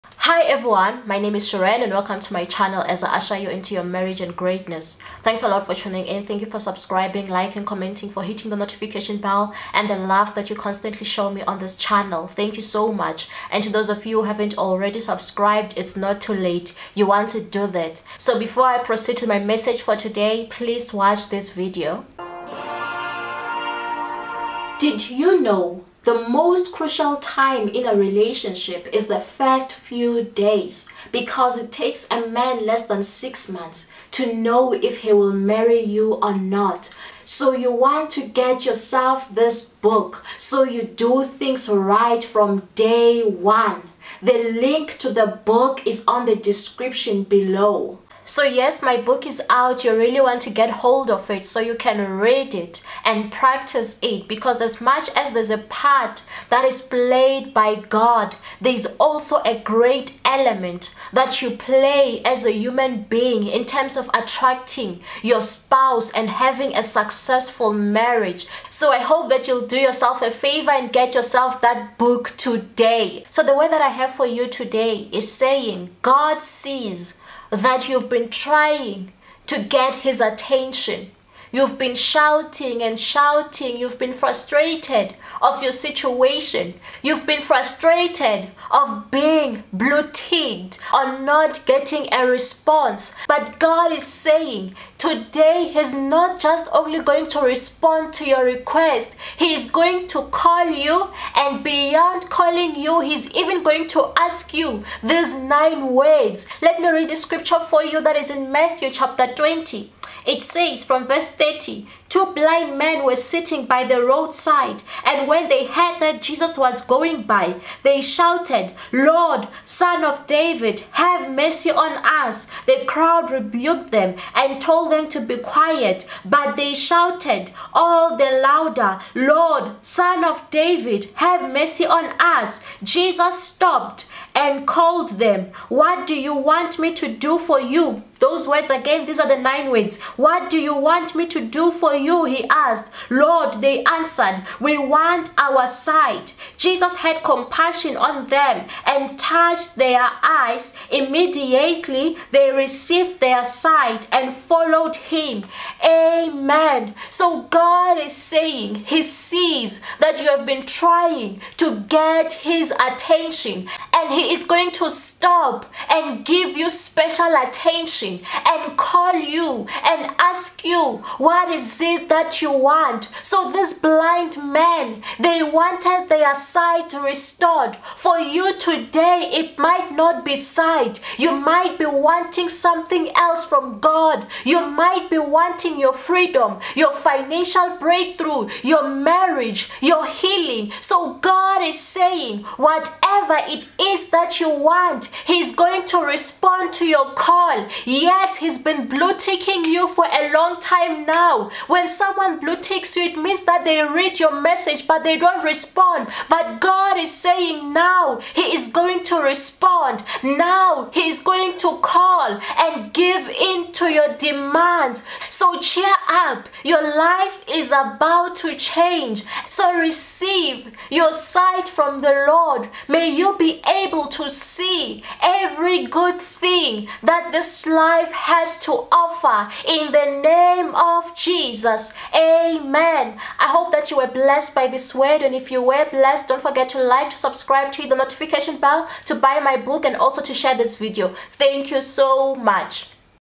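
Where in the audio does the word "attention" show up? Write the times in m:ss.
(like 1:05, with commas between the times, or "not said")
1:20, 2:42, 2:47.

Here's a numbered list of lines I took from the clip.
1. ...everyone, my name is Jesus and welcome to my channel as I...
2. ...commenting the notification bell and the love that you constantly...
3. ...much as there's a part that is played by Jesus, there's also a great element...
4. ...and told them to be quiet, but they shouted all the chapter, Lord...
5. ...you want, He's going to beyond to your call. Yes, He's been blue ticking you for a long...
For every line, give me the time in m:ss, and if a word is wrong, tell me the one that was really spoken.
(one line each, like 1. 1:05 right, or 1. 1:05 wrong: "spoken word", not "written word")
1. 0:00 wrong: "Xiren", not "Jesus"
2. 0:08 wrong: "hitting", not "commenting"
3. 0:54 wrong: "God", not "Jesus"
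4. 2:04 wrong: "louder", not "chapter"
5. 3:14 wrong: "respond", not "beyond".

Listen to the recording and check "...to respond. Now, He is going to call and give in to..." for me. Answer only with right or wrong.
right.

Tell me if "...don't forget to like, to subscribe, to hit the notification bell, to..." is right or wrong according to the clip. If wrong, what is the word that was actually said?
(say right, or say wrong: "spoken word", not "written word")
right.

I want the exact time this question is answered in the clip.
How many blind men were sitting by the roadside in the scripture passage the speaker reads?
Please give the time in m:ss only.
1:52.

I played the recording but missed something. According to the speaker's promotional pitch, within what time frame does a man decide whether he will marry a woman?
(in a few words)
less than 6 months.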